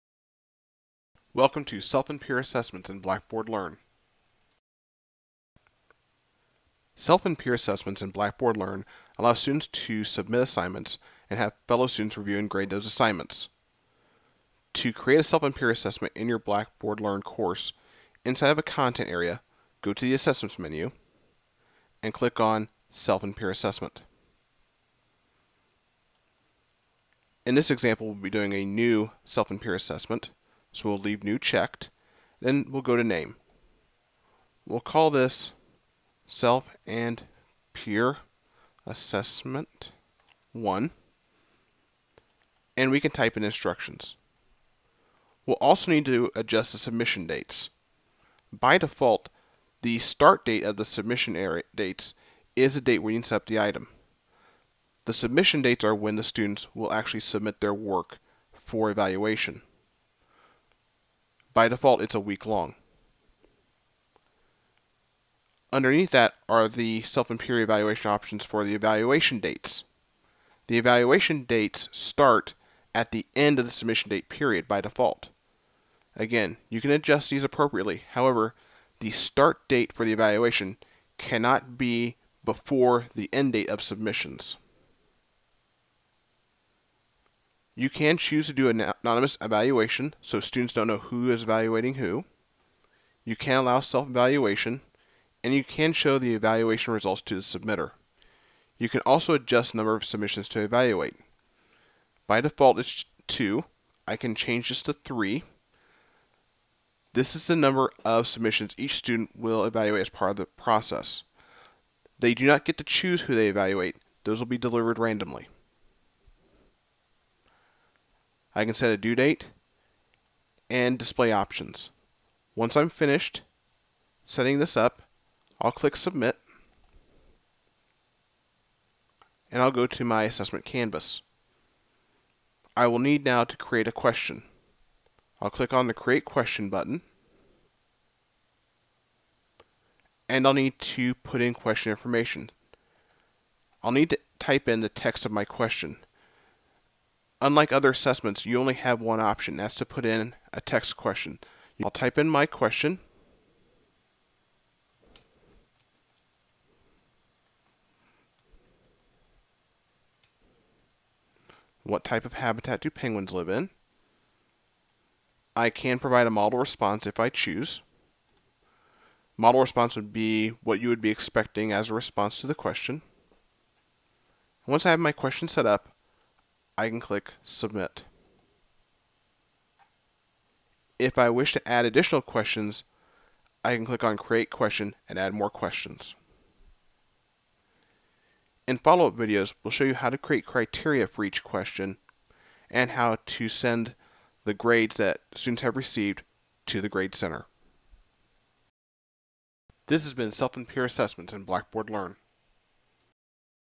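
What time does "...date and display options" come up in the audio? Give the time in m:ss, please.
1:59.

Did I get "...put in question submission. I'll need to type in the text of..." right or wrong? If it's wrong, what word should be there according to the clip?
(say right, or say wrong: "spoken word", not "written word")
wrong: "information", not "submission".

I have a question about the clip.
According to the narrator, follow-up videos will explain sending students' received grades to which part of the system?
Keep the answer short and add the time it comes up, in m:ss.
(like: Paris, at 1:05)
Grade Center, at 3:16.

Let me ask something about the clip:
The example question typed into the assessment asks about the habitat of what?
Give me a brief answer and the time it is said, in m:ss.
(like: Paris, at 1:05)
penguins, at 2:42.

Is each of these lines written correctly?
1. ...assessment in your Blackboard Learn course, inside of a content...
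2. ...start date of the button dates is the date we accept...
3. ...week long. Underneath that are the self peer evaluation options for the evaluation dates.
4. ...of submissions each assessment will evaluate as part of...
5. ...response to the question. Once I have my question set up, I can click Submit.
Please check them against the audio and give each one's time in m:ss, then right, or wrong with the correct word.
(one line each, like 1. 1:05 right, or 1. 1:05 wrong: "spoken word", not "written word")
1. 0:15 right
2. 0:49 wrong: "submission", not "button"
3. 1:02 right
4. 1:48 wrong: "student", not "assessment"
5. 2:51 right.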